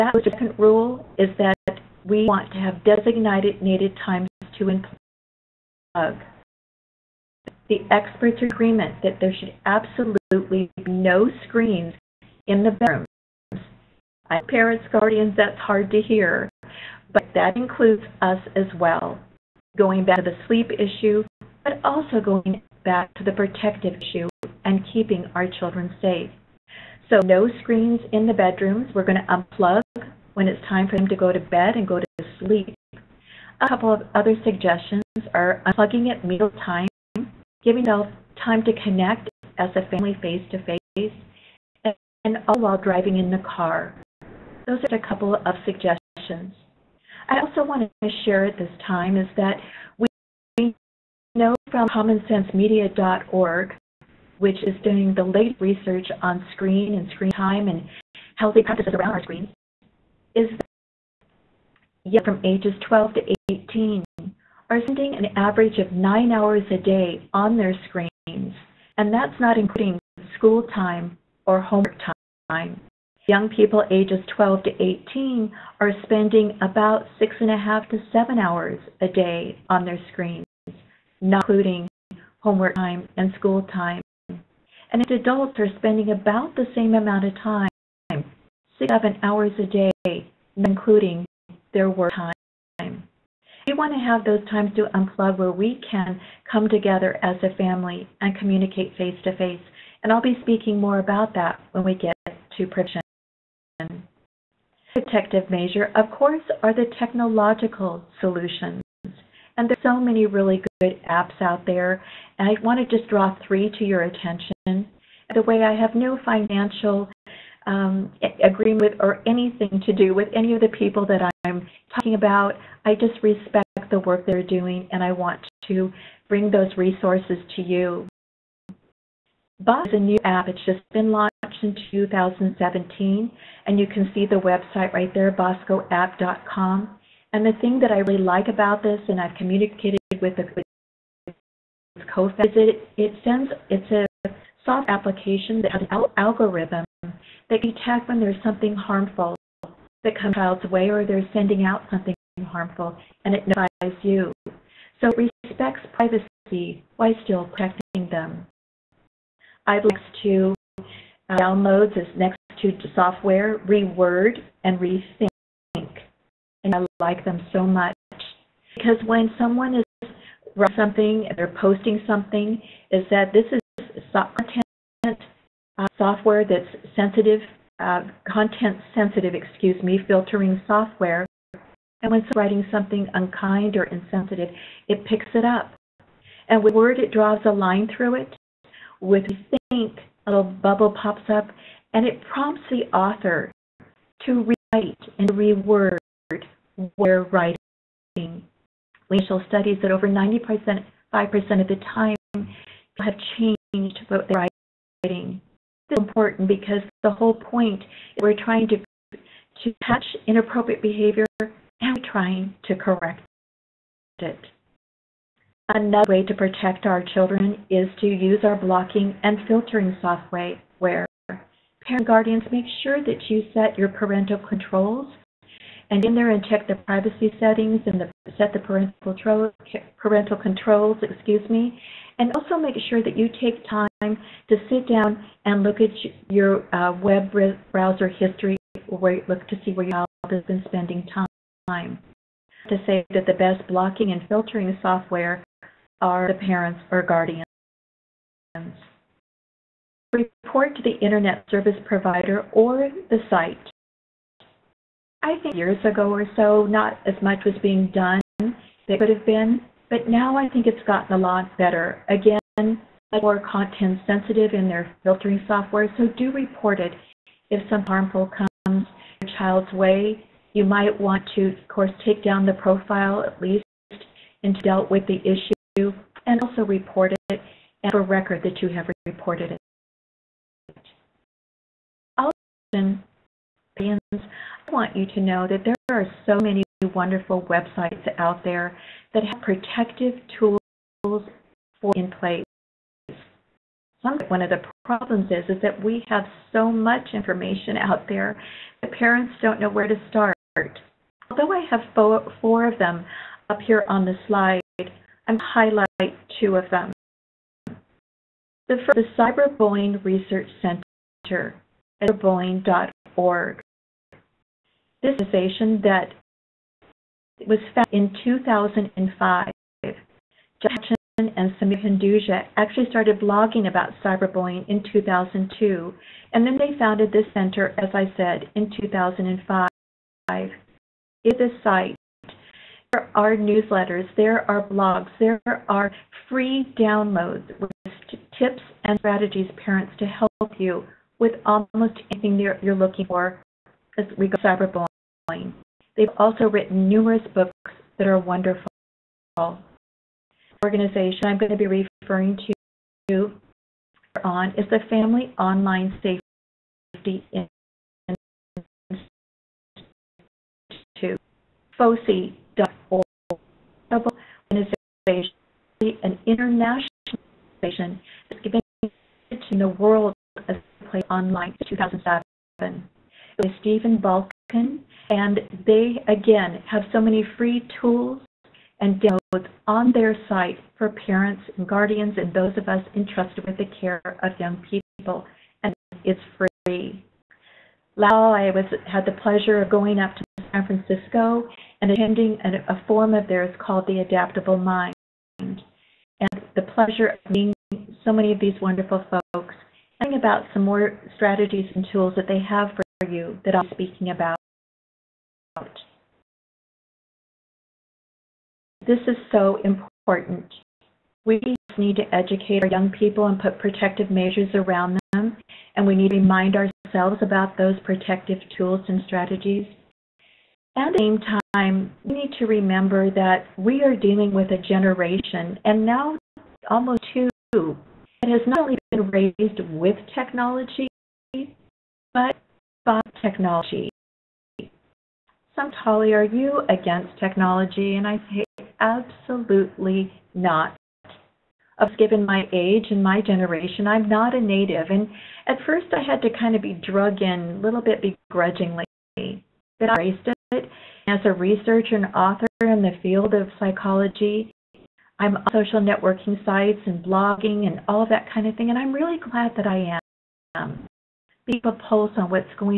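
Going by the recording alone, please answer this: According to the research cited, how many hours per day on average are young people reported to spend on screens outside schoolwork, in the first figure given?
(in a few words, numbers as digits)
9.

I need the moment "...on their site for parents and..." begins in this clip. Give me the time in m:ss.
6:19.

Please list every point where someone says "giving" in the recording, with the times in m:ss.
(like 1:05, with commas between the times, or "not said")
0:37, 6:08.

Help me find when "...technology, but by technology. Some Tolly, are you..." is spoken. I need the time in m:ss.
7:10.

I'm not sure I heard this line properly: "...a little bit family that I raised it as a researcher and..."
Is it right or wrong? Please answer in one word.
wrong.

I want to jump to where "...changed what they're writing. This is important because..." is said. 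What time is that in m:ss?
3:23.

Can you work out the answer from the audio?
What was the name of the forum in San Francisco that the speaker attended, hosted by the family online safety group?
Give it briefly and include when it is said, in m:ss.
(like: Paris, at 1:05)
The Adaptable Mind, at 6:33.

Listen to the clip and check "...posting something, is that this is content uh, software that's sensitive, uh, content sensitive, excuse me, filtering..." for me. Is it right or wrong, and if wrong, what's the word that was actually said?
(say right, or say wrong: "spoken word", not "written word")
right.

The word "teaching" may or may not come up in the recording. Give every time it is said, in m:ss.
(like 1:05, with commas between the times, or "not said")
not said.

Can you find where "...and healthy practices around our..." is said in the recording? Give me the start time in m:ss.
0:57.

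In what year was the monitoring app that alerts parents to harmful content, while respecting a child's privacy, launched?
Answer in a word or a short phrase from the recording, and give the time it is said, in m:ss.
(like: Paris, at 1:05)
2017, at 2:11.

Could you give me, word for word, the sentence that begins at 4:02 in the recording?
To say that the best blocking and filtering software are the parents or guardians.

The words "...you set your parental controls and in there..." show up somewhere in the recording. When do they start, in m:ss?
3:43.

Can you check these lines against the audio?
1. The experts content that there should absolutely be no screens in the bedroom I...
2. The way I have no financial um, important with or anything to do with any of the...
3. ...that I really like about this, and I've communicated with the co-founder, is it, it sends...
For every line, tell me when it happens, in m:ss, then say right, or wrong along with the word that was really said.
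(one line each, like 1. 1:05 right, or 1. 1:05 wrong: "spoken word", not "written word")
1. 0:07 wrong: "agreement", not "content"
2. 1:55 wrong: "agreement", not "important"
3. 2:17 right.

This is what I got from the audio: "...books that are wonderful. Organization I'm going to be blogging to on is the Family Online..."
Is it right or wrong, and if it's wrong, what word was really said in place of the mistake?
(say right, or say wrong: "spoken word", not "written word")
wrong: "referring", not "blogging".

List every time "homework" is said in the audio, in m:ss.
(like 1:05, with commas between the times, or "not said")
1:11, 1:22.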